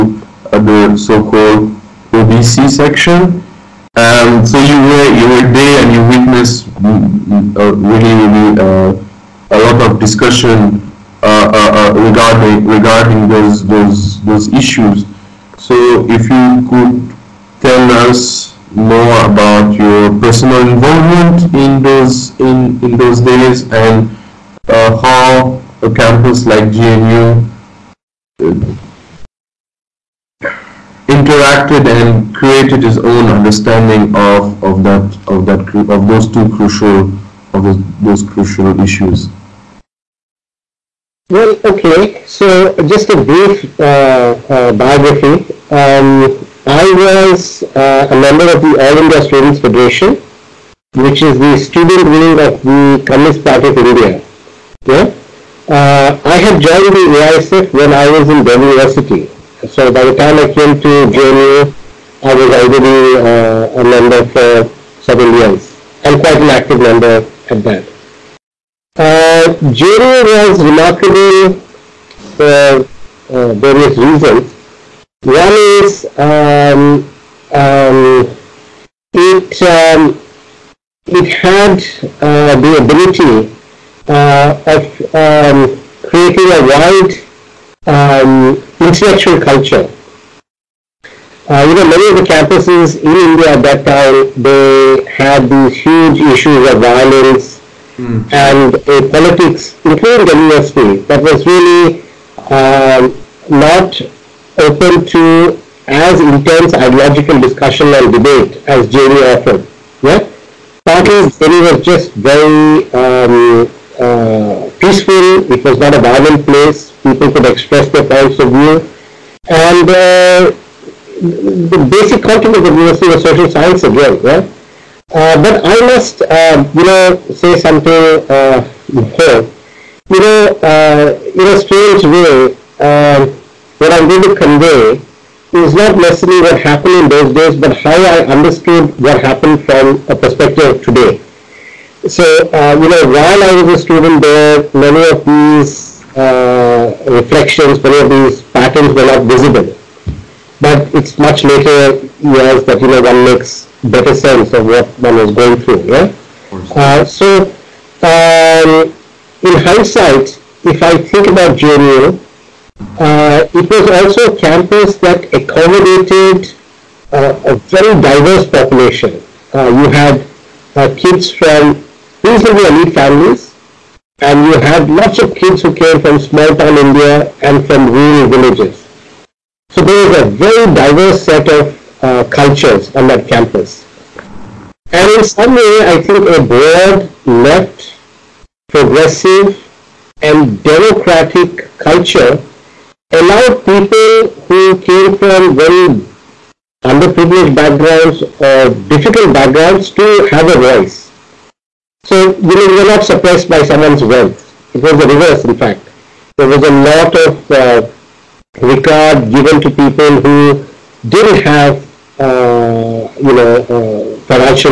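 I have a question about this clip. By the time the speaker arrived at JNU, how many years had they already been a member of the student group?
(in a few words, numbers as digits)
7.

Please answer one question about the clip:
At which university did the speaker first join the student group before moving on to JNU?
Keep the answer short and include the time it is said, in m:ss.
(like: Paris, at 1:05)
Delhi University, at 0:58.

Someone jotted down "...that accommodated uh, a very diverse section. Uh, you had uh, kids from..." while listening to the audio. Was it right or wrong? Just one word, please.
wrong.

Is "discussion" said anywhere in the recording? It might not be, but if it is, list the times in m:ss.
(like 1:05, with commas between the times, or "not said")
0:10, 1:47.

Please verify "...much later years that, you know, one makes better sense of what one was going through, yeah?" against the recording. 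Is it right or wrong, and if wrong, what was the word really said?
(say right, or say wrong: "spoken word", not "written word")
right.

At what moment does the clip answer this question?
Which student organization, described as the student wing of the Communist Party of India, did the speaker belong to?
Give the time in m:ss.
0:48.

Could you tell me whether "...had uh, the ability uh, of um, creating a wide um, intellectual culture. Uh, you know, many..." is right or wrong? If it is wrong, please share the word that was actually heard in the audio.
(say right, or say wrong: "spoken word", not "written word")
right.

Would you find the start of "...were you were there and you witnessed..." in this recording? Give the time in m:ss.
0:04.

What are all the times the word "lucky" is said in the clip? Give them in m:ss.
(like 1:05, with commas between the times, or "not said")
not said.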